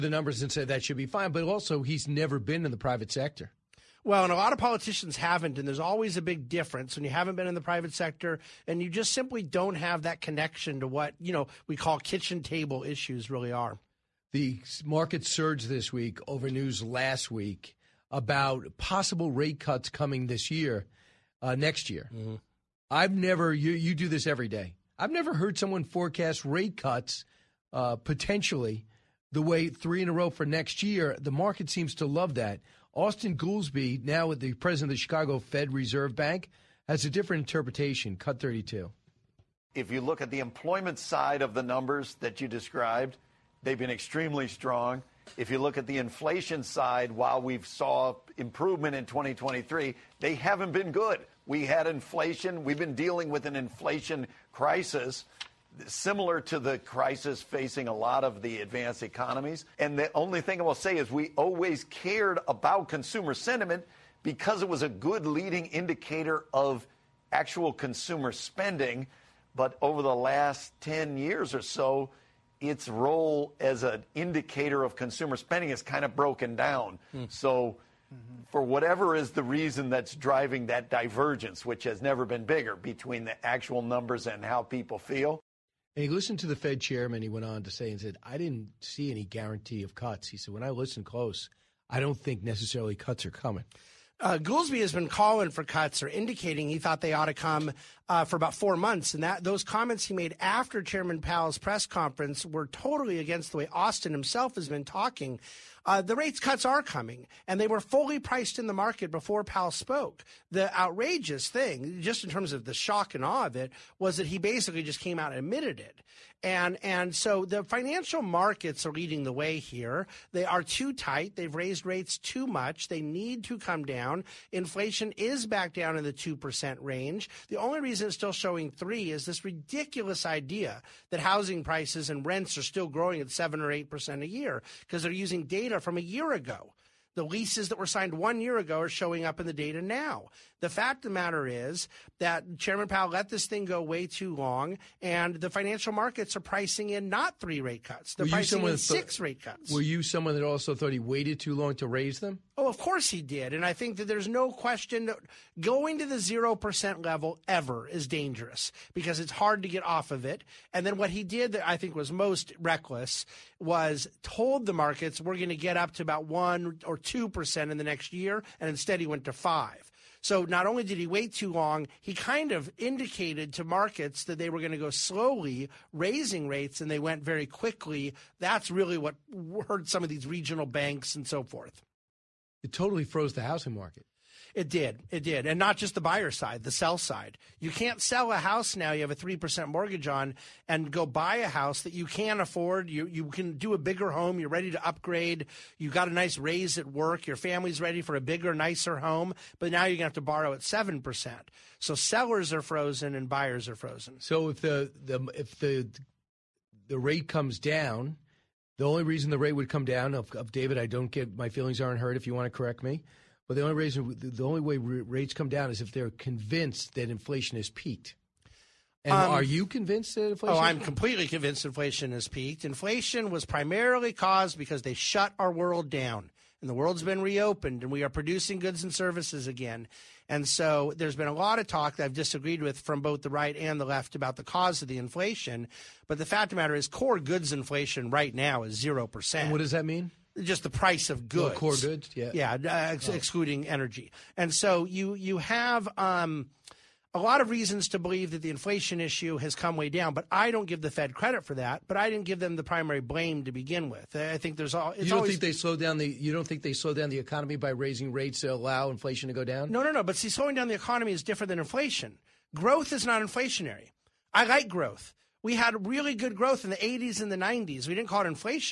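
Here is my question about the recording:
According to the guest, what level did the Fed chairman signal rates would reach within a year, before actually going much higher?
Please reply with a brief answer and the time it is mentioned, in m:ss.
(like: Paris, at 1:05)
1 or 2%, at 2:46.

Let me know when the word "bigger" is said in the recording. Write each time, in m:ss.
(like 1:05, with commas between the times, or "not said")
1:22, 3:13, 3:18.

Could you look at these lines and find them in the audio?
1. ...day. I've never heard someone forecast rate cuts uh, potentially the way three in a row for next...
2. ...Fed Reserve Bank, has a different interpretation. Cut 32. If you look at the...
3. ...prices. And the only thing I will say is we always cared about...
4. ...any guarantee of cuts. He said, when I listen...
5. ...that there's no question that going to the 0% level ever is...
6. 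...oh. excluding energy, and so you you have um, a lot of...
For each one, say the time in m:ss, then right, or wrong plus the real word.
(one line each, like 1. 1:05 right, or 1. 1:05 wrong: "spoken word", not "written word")
1. 0:24 right
2. 0:35 right
3. 0:59 wrong: "economies", not "prices"
4. 1:29 right
5. 2:33 right
6. 4:03 right.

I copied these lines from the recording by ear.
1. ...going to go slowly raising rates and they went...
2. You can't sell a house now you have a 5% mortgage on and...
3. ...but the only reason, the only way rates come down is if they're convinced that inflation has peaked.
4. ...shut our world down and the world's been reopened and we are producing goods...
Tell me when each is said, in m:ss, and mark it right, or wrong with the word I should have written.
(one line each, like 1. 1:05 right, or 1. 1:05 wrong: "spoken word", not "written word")
1. 2:54 right
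2. 3:07 wrong: "3", not "5"
3. 3:33 right
4. 3:44 right.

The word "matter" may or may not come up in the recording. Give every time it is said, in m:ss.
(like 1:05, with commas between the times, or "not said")
2:21, 3:56.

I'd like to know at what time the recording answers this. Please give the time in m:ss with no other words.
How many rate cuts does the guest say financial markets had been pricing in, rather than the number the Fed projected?
2:28.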